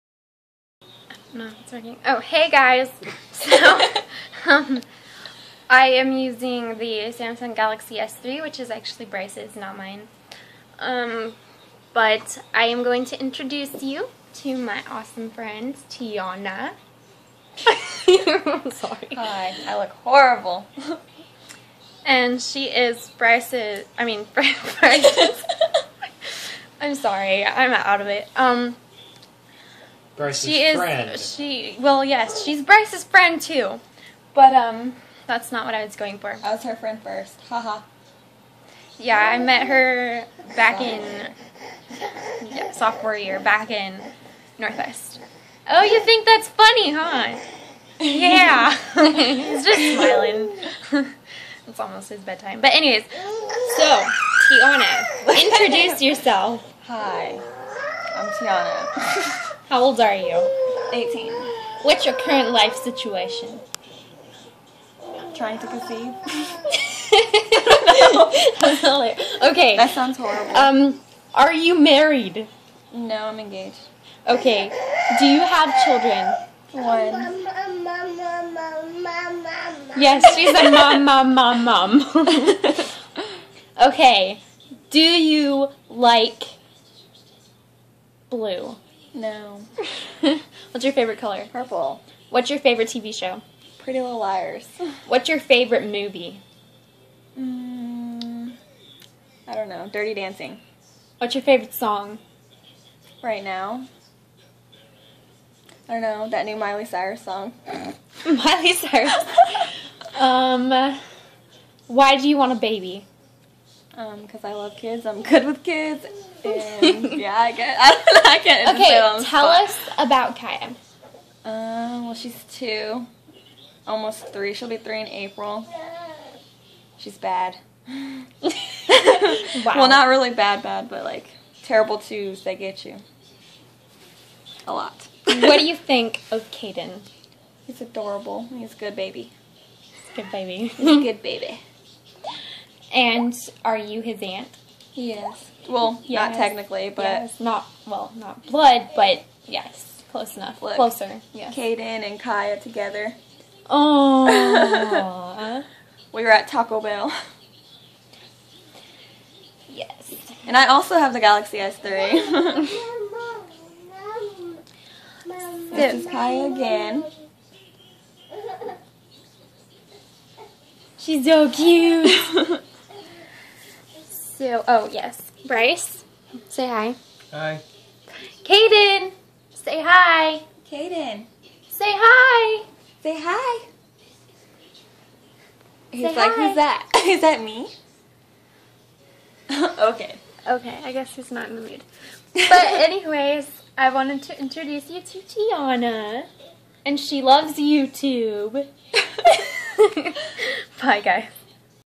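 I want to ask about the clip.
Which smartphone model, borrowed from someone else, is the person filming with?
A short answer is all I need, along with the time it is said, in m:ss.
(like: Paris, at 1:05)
Samsung Galaxy S3, at 0:07.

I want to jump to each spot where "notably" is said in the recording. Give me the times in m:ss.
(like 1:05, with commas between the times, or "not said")
not said.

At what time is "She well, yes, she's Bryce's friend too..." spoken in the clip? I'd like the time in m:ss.
0:31.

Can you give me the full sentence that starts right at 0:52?
But anyways, so Tianna, introduce yourself.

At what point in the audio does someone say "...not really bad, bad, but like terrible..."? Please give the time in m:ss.
2:09.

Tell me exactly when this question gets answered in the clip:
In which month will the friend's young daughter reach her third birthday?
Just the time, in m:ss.
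2:05.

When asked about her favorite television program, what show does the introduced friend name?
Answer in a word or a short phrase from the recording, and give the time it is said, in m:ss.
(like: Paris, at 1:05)
Pretty Little Liars, at 1:33.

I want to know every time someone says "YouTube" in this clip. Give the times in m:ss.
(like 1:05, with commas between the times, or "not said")
3:17.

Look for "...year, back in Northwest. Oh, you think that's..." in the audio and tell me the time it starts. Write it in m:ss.
0:43.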